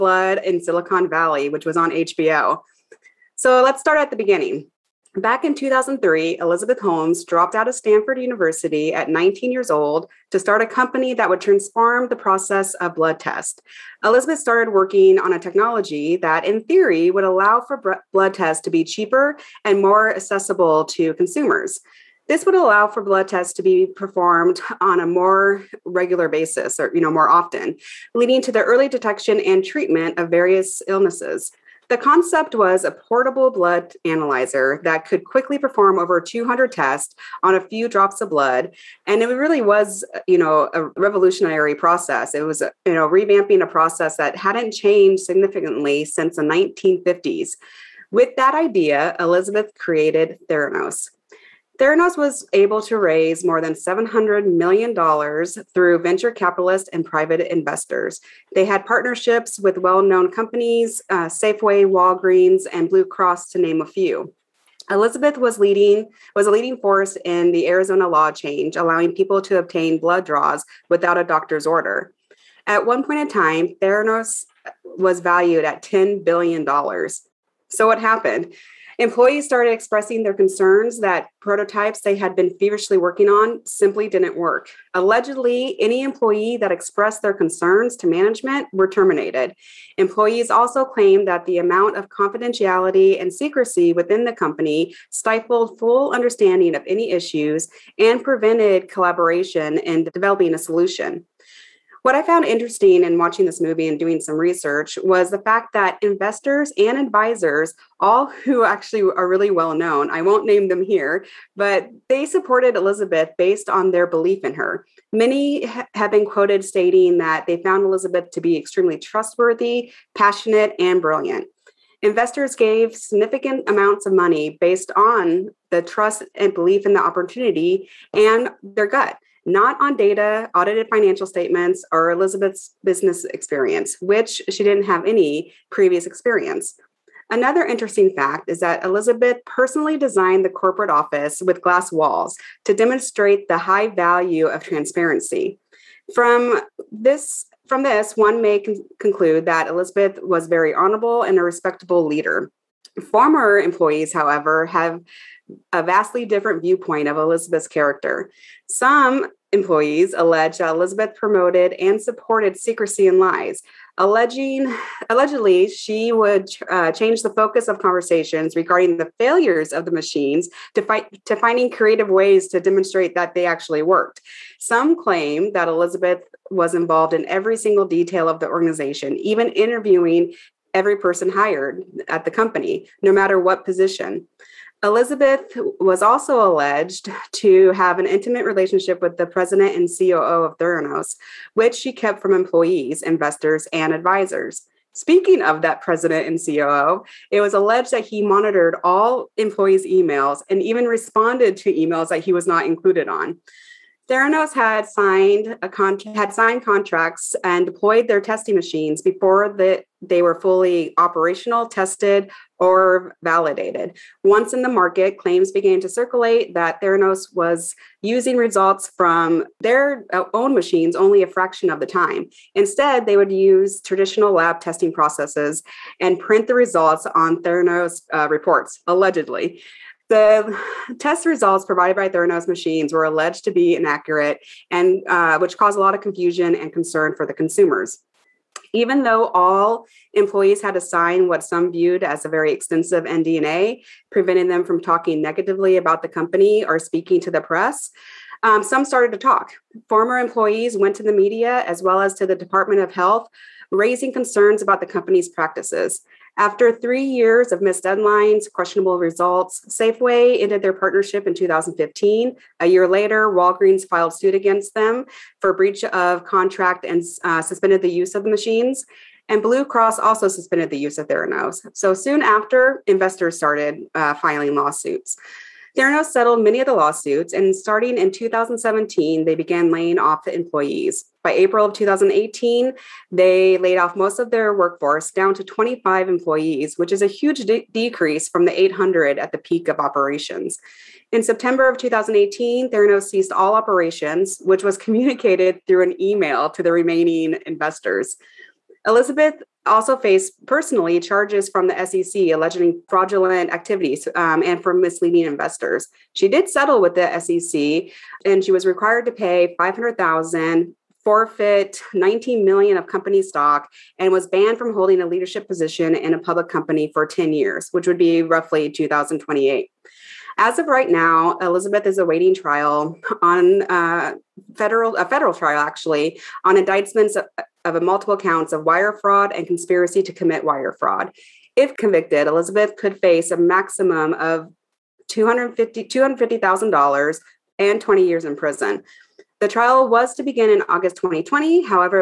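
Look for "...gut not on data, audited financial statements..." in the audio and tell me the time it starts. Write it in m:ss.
2:08.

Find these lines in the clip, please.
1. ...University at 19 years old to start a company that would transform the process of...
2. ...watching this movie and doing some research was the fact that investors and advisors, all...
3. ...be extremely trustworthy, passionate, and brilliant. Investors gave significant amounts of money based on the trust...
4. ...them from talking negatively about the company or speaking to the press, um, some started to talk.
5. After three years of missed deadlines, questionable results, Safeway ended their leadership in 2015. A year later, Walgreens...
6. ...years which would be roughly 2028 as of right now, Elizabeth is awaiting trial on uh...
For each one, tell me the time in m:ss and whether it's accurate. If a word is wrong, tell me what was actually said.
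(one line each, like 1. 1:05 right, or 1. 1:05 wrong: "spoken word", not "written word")
1. 0:08 right
2. 1:43 right
3. 1:58 right
4. 4:04 right
5. 4:16 wrong: "partnership", not "leadership"
6. 5:17 right.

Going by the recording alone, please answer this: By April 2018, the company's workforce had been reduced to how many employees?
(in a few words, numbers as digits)
25.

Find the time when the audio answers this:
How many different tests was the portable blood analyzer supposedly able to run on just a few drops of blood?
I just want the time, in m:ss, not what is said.
0:35.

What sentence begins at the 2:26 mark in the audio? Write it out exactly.
From this, from this one may con- conclude that Elizabeth was very honorable and a respectable leader.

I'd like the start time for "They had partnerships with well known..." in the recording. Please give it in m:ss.
0:58.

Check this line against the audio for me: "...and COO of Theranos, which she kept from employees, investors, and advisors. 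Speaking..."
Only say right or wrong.
right.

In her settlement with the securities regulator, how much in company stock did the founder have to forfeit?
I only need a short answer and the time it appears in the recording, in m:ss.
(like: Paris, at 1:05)
19 million, at 5:11.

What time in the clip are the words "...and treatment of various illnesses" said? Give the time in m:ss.
0:29.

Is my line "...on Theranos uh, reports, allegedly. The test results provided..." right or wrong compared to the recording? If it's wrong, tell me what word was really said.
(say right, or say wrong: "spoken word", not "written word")
right.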